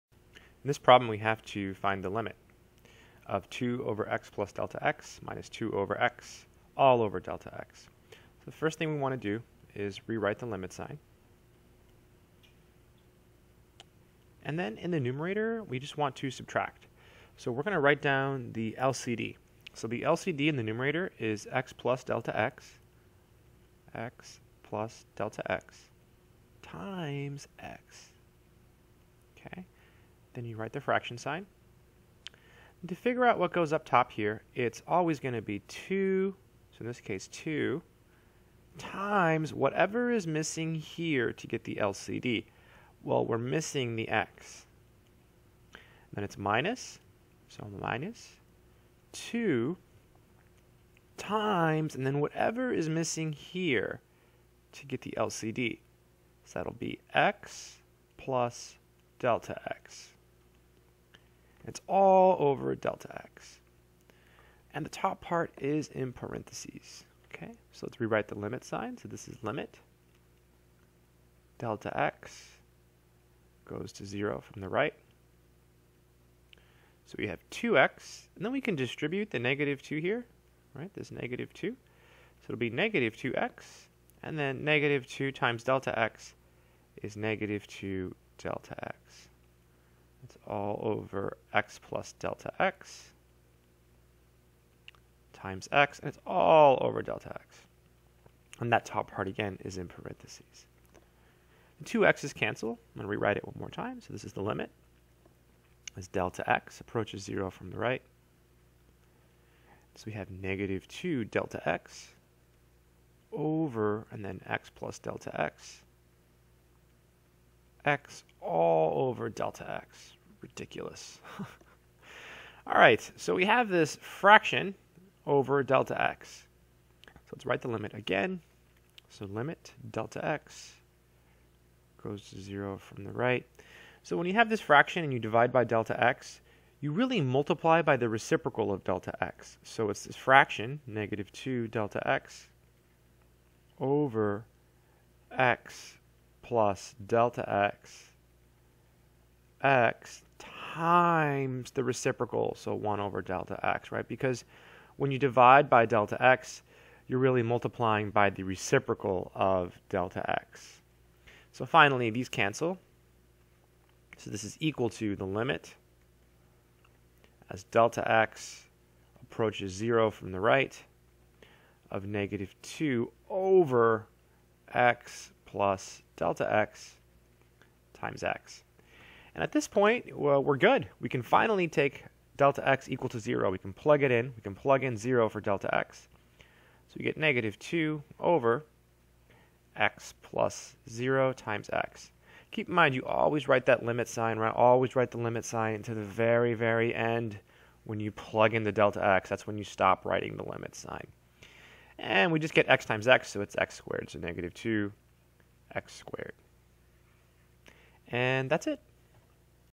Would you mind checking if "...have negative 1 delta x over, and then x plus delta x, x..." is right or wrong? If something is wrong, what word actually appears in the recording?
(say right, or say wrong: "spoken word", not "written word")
wrong: "2", not "1".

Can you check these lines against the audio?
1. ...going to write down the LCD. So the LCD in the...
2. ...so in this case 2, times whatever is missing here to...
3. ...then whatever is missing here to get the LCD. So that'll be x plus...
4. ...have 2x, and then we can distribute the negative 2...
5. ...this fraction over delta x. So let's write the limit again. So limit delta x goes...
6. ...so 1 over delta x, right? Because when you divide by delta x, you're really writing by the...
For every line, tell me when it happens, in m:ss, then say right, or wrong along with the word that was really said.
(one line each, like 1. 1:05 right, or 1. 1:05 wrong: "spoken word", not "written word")
1. 0:17 right
2. 0:36 right
3. 0:52 right
4. 1:17 right
5. 2:03 right
6. 2:32 wrong: "multiplying", not "writing".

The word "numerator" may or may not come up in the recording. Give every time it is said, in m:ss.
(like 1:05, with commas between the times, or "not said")
0:14, 0:20.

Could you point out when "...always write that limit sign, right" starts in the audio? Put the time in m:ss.
3:13.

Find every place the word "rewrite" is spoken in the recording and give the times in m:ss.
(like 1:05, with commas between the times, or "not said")
0:10, 1:07, 1:43.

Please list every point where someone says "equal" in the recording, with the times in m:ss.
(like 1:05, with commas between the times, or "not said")
2:44, 3:02.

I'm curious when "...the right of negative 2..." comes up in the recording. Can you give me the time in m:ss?
2:50.